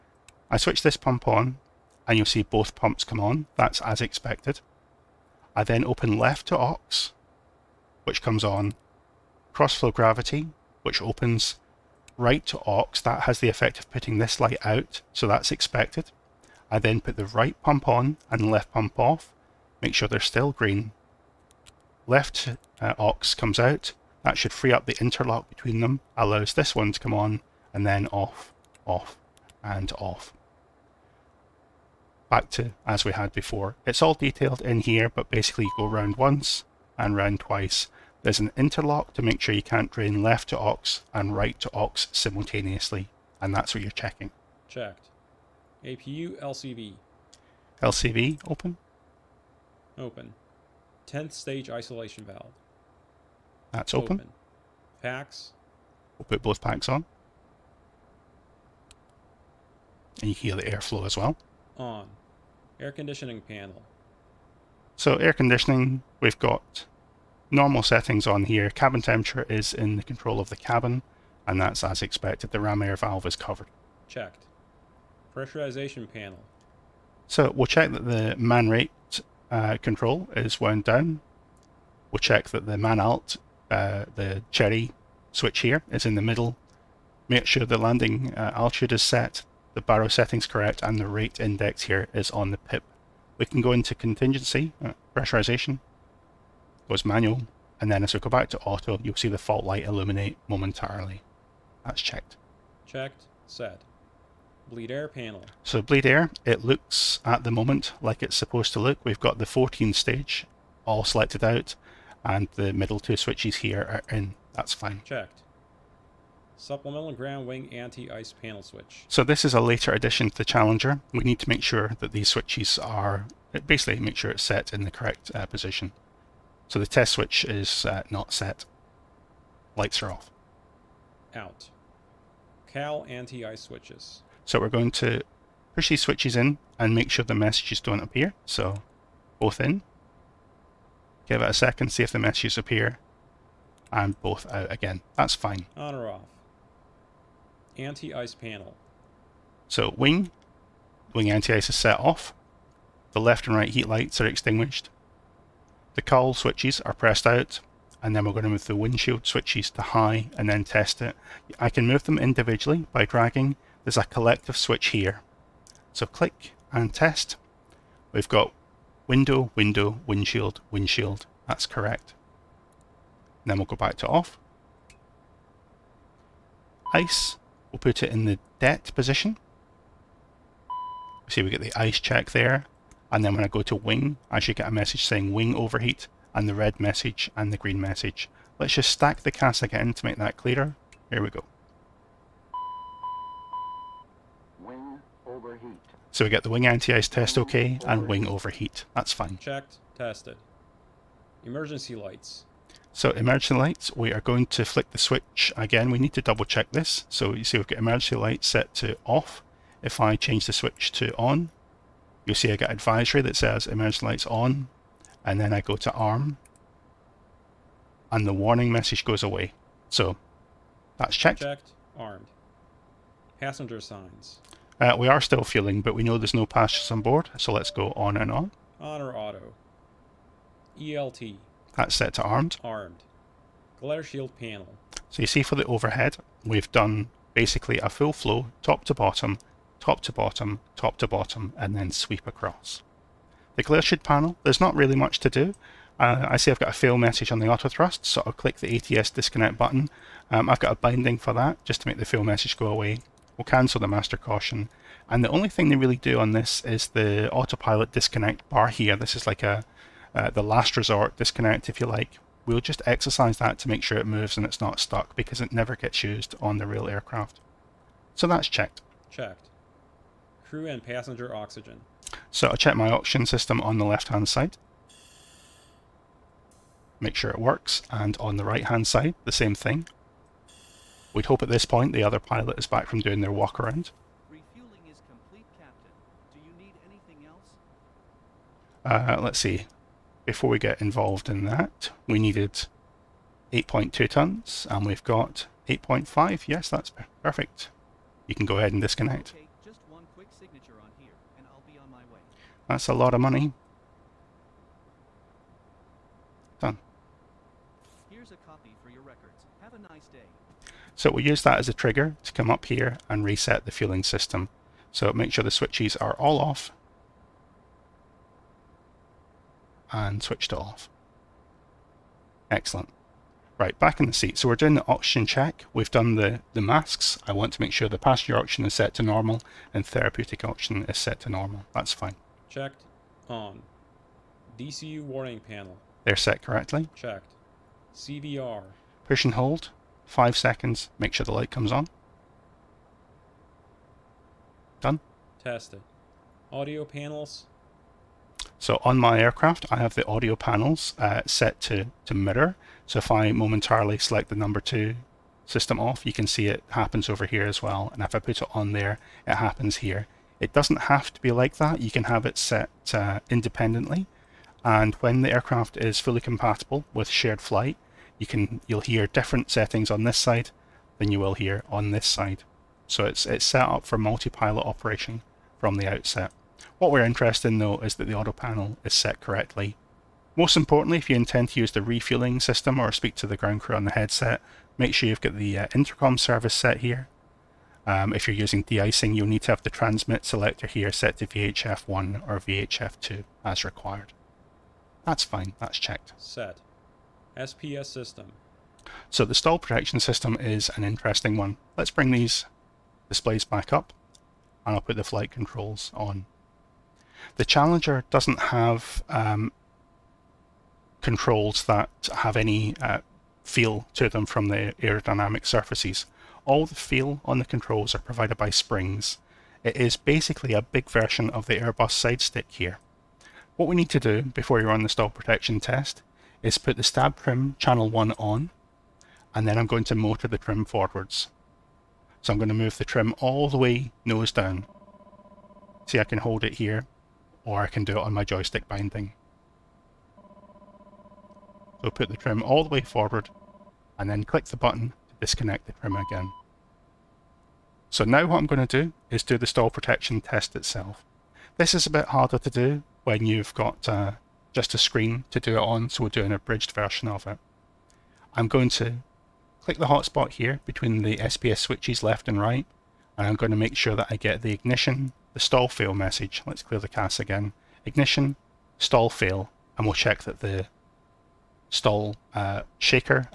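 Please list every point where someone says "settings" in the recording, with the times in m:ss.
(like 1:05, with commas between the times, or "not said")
1:07, 1:30, 6:09.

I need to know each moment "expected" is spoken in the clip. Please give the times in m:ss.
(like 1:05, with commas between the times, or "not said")
0:03, 0:15, 1:12.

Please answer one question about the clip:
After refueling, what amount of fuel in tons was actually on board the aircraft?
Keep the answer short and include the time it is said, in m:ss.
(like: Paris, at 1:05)
8.5, at 4:55.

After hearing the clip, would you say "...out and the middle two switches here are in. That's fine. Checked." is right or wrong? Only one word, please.
right.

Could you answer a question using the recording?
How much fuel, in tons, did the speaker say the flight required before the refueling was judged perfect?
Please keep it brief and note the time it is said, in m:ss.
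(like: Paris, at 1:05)
8.2 tons, at 4:53.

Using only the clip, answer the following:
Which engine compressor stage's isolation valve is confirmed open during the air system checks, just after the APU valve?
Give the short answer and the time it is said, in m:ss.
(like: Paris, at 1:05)
10th stage, at 0:51.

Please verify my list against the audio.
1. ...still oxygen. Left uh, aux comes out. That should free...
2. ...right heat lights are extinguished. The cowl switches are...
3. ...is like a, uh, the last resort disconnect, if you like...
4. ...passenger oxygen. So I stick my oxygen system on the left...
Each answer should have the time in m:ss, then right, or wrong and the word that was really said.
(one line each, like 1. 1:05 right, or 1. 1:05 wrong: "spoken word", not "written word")
1. 0:20 wrong: "green", not "oxygen"
2. 2:33 right
3. 4:19 right
4. 4:30 wrong: "check", not "stick".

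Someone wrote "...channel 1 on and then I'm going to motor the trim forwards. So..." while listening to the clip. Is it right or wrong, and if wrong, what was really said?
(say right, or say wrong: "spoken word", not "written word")
right.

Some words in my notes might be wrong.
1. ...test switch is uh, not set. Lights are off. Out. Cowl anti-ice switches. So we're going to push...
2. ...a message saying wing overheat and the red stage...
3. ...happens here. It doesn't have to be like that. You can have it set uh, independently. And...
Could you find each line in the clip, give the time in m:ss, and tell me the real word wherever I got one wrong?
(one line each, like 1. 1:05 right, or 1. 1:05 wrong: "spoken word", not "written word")
1. 2:06 right
2. 3:04 wrong: "message", not "stage"
3. 5:59 right.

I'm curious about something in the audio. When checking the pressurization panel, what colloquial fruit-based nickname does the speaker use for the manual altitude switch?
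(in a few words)
cherry switch.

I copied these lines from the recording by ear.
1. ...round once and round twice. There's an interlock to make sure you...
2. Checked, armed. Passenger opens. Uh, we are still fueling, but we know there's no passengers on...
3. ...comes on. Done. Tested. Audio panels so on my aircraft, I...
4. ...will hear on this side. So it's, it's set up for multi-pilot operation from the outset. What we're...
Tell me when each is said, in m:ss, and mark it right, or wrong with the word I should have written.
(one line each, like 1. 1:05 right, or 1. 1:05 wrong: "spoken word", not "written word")
1. 0:35 right
2. 3:41 wrong: "signs", not "opens"
3. 5:41 right
4. 6:11 right.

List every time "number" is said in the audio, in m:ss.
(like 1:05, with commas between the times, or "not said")
5:54.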